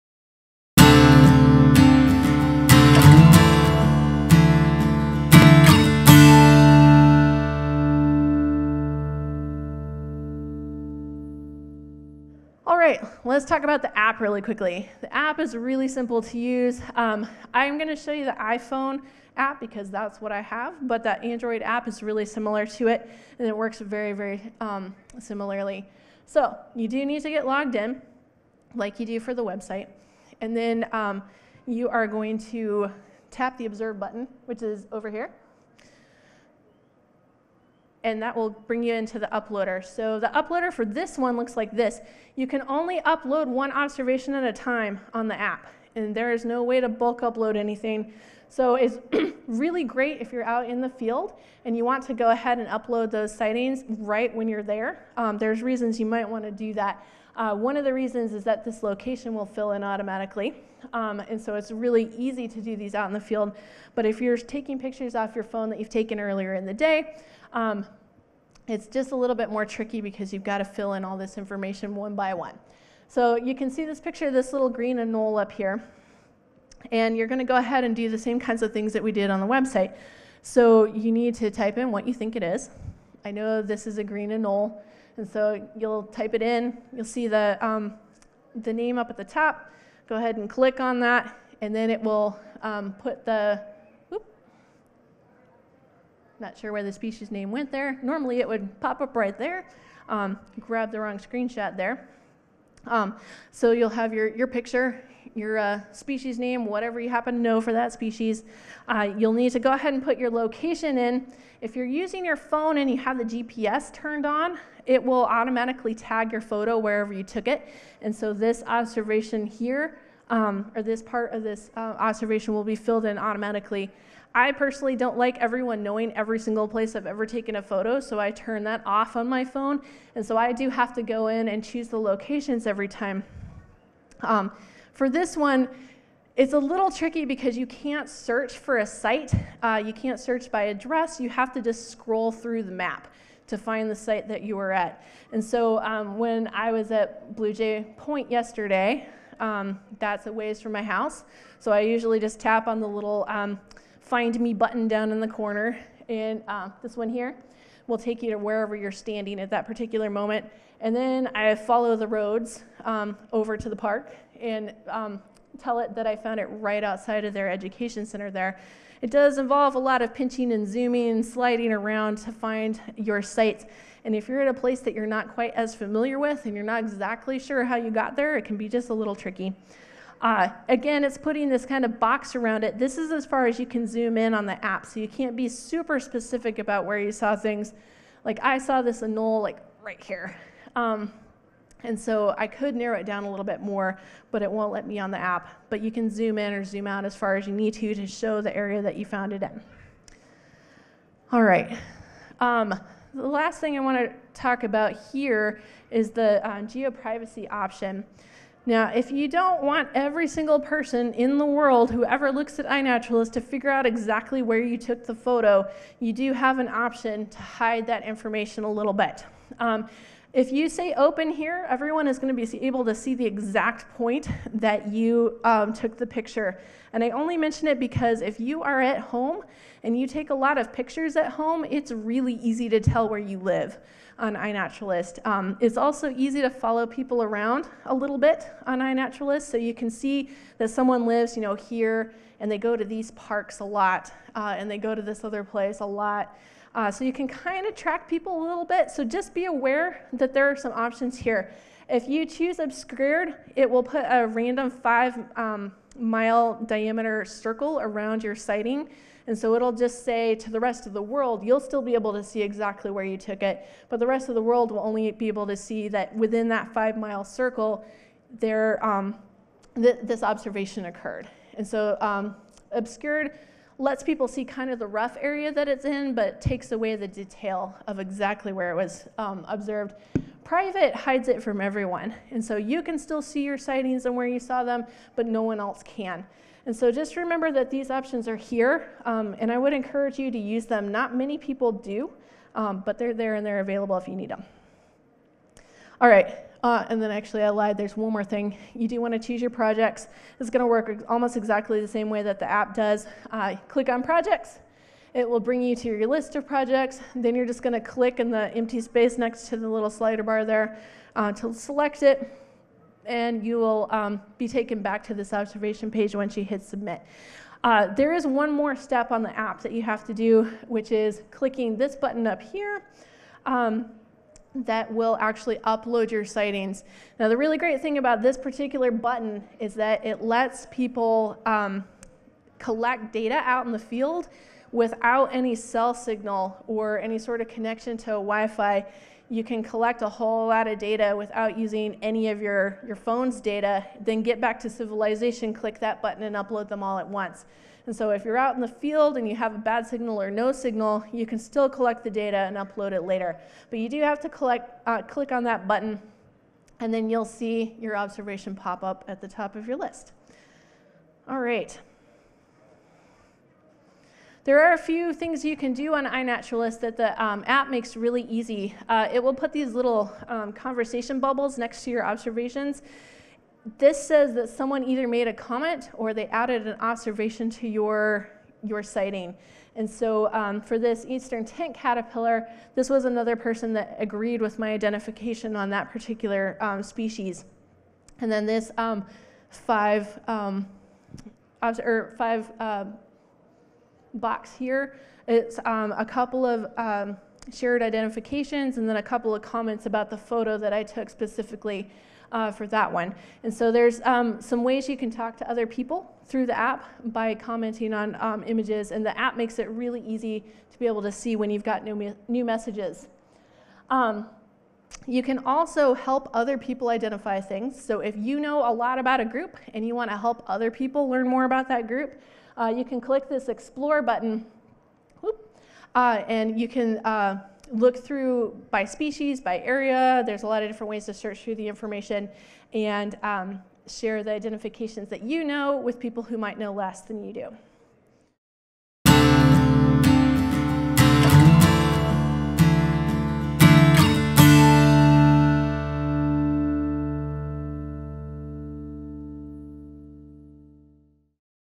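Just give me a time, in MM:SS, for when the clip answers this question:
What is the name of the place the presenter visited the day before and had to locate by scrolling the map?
02:27.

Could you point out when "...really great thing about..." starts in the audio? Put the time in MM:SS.
05:27.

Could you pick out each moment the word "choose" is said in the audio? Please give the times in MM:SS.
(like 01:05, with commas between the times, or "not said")
02:11, 04:12, 04:59.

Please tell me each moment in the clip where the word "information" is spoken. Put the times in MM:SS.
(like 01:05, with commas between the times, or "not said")
01:11, 03:38, 07:11.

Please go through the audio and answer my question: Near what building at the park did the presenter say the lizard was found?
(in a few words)
education center.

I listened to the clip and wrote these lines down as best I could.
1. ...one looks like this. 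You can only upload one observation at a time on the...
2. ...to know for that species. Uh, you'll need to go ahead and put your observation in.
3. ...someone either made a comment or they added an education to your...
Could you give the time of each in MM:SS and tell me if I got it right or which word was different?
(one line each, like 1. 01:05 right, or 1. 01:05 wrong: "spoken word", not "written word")
1. 00:41 right
2. 01:47 wrong: "location", not "observation"
3. 06:14 wrong: "observation", not "education".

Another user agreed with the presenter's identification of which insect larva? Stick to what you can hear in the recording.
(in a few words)
Eastern tent caterpillar.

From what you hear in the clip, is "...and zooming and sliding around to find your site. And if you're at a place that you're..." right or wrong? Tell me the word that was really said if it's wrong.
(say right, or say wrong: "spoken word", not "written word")
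right.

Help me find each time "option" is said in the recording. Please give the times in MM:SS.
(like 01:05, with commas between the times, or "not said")
03:27, 03:36, 04:10, 04:47.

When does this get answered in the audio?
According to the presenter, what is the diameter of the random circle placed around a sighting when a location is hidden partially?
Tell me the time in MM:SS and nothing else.
04:14.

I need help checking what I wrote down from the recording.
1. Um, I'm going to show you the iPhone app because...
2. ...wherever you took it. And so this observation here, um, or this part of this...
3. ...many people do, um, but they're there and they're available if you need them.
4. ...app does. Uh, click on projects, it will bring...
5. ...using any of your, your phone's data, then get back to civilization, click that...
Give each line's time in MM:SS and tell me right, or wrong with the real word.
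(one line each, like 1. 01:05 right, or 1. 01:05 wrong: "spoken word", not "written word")
1. 00:16 right
2. 01:56 right
3. 04:51 right
4. 05:02 right
5. 05:41 right.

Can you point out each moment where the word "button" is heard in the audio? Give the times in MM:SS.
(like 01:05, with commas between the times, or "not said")
00:33, 02:34, 05:21, 05:28, 05:46, 05:55, 07:04.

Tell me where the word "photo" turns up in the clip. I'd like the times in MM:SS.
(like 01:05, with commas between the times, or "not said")
01:56, 02:07, 03:35, 06:40.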